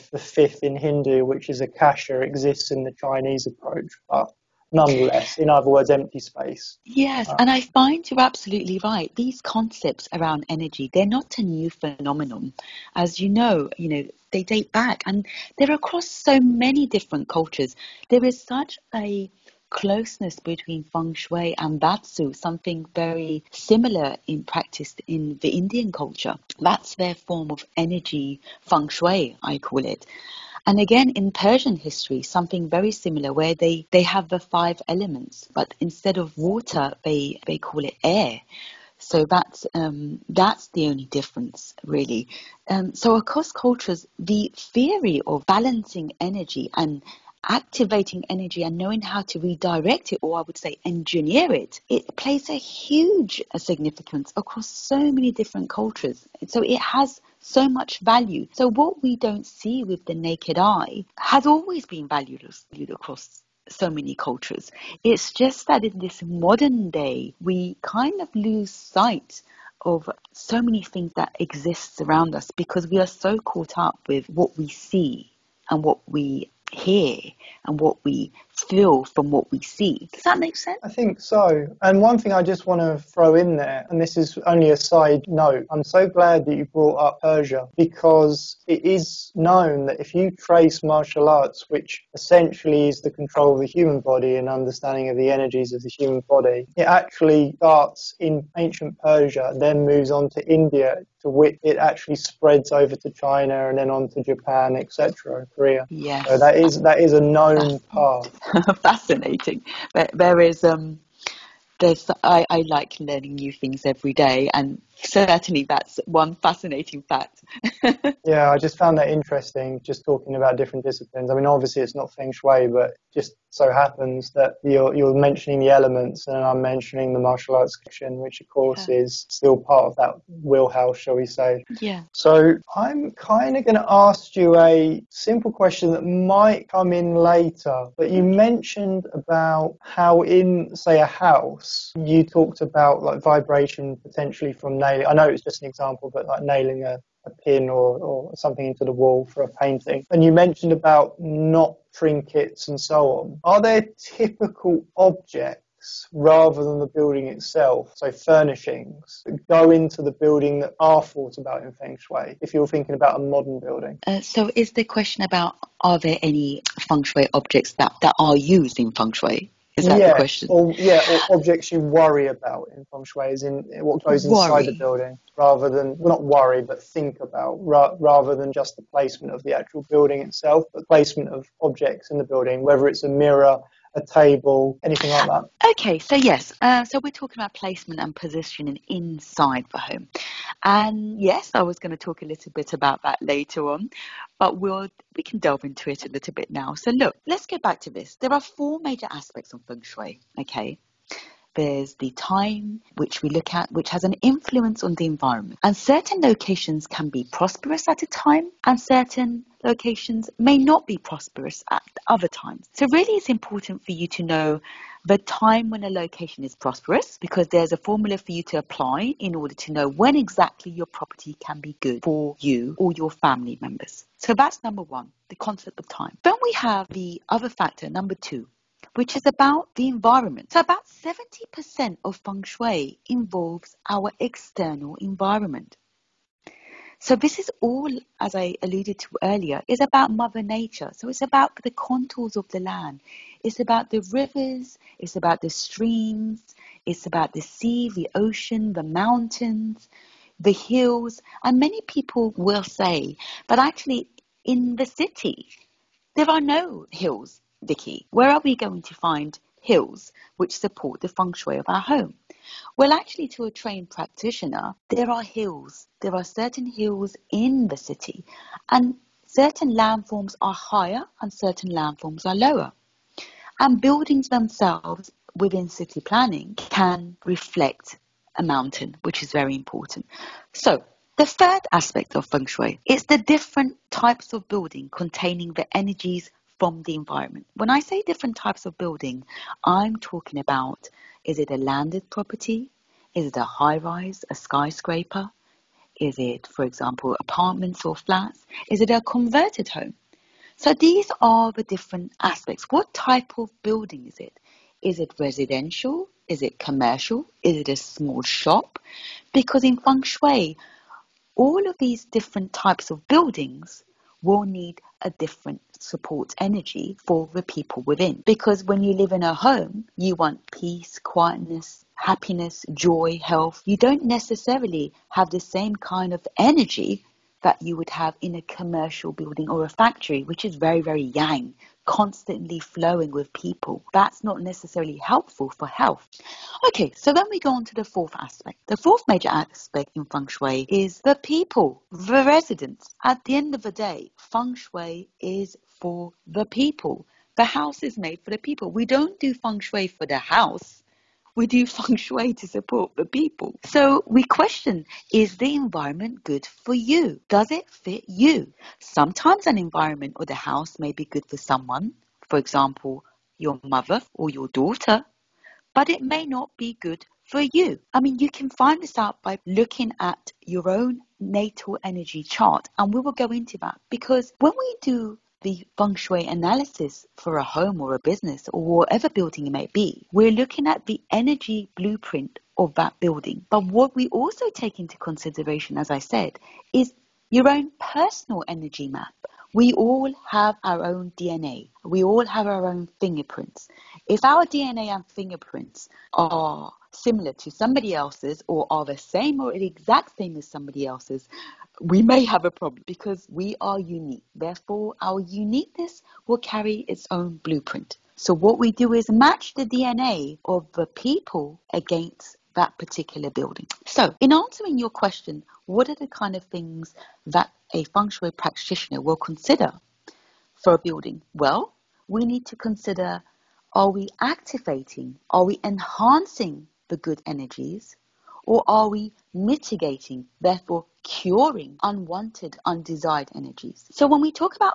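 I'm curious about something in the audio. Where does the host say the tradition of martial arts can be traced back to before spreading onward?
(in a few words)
Ancient Persia.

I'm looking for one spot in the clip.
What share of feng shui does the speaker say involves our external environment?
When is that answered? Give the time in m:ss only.
3:50.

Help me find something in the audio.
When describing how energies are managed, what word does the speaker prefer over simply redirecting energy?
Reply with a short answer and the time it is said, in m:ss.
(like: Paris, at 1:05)
Engineer, at 0:50.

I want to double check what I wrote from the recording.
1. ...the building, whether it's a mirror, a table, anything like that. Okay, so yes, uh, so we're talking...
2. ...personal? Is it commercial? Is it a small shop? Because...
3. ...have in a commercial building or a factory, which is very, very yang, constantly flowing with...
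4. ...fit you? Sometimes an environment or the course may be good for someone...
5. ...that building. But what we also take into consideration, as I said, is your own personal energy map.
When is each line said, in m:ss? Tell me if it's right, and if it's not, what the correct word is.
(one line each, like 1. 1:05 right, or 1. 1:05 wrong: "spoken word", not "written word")
1. 3:02 right
2. 5:05 wrong: "residential", not "personal"
3. 5:27 right
4. 5:57 wrong: "house", not "course"
5. 6:22 right.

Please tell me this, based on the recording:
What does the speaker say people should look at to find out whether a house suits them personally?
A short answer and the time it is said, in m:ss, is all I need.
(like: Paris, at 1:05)
Natal energy chart, at 6:11.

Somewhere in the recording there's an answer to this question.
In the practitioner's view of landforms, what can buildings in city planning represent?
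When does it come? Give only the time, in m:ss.
4:38.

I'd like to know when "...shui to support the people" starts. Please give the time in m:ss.
5:51.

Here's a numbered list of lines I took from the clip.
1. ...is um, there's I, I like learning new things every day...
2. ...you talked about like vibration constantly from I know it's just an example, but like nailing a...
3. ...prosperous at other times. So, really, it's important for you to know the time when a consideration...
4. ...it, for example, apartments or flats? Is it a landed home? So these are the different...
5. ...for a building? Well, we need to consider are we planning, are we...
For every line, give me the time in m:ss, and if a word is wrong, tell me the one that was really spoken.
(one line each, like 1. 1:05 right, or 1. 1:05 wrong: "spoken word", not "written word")
1. 1:50 right
2. 2:21 wrong: "potentially", not "constantly"
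3. 3:30 wrong: "location", not "consideration"
4. 4:56 wrong: "converted", not "landed"
5. 7:00 wrong: "activating", not "planning".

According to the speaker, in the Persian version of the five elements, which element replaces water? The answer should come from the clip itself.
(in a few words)
Air.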